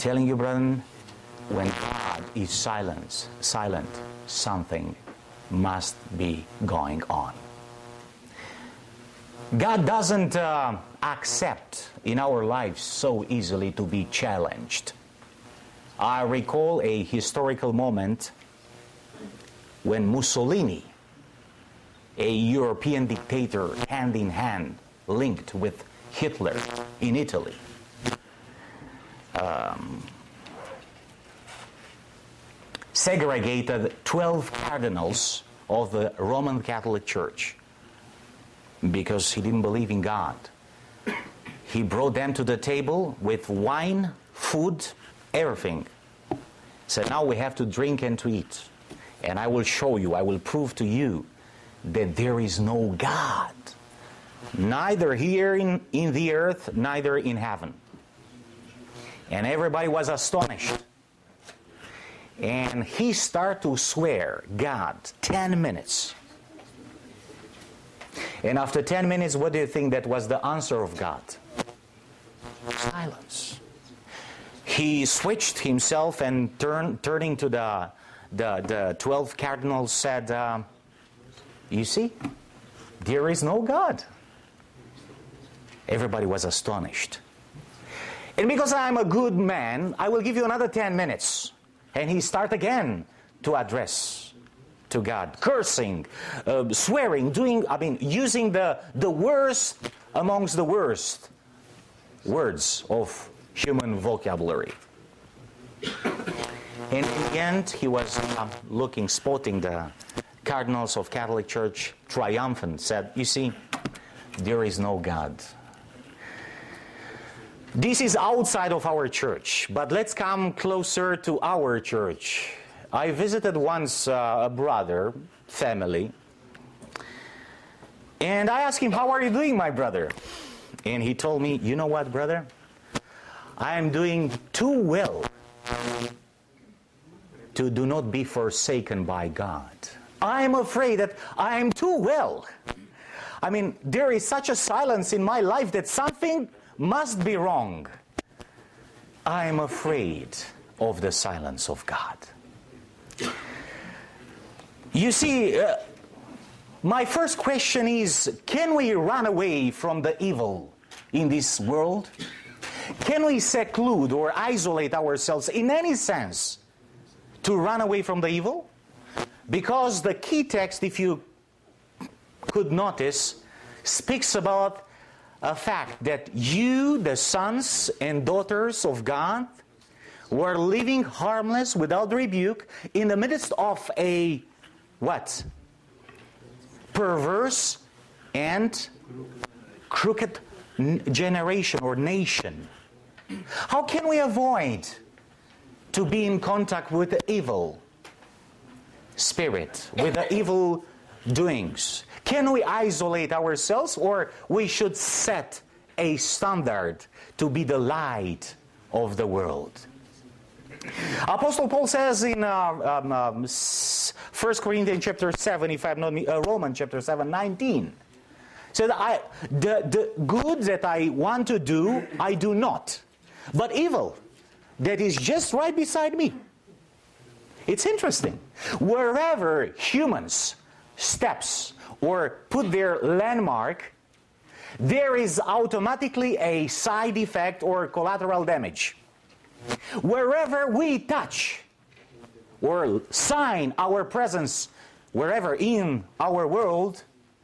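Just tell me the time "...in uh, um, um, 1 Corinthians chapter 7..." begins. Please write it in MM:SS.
03:32.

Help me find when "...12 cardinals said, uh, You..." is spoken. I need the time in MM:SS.
01:18.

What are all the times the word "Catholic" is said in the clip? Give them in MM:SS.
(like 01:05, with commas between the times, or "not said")
00:36, 01:51.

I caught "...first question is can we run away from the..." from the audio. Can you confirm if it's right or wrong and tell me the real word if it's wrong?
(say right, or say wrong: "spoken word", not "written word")
right.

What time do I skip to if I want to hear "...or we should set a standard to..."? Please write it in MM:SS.
03:23.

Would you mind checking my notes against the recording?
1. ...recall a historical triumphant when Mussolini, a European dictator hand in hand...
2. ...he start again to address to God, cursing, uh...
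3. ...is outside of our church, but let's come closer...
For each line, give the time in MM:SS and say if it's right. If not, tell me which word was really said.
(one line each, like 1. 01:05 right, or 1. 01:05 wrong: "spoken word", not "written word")
1. 00:16 wrong: "moment", not "triumphant"
2. 01:32 right
3. 01:58 right.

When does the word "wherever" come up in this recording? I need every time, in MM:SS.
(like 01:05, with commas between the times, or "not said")
03:48, 04:00, 04:05.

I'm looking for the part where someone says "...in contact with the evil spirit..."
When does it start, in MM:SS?
03:16.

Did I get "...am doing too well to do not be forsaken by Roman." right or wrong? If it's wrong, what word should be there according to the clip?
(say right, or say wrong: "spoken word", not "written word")
wrong: "God", not "Roman".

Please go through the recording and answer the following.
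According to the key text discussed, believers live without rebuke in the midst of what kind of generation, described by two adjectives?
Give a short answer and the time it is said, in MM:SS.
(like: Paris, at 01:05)
perverse and crooked, at 03:06.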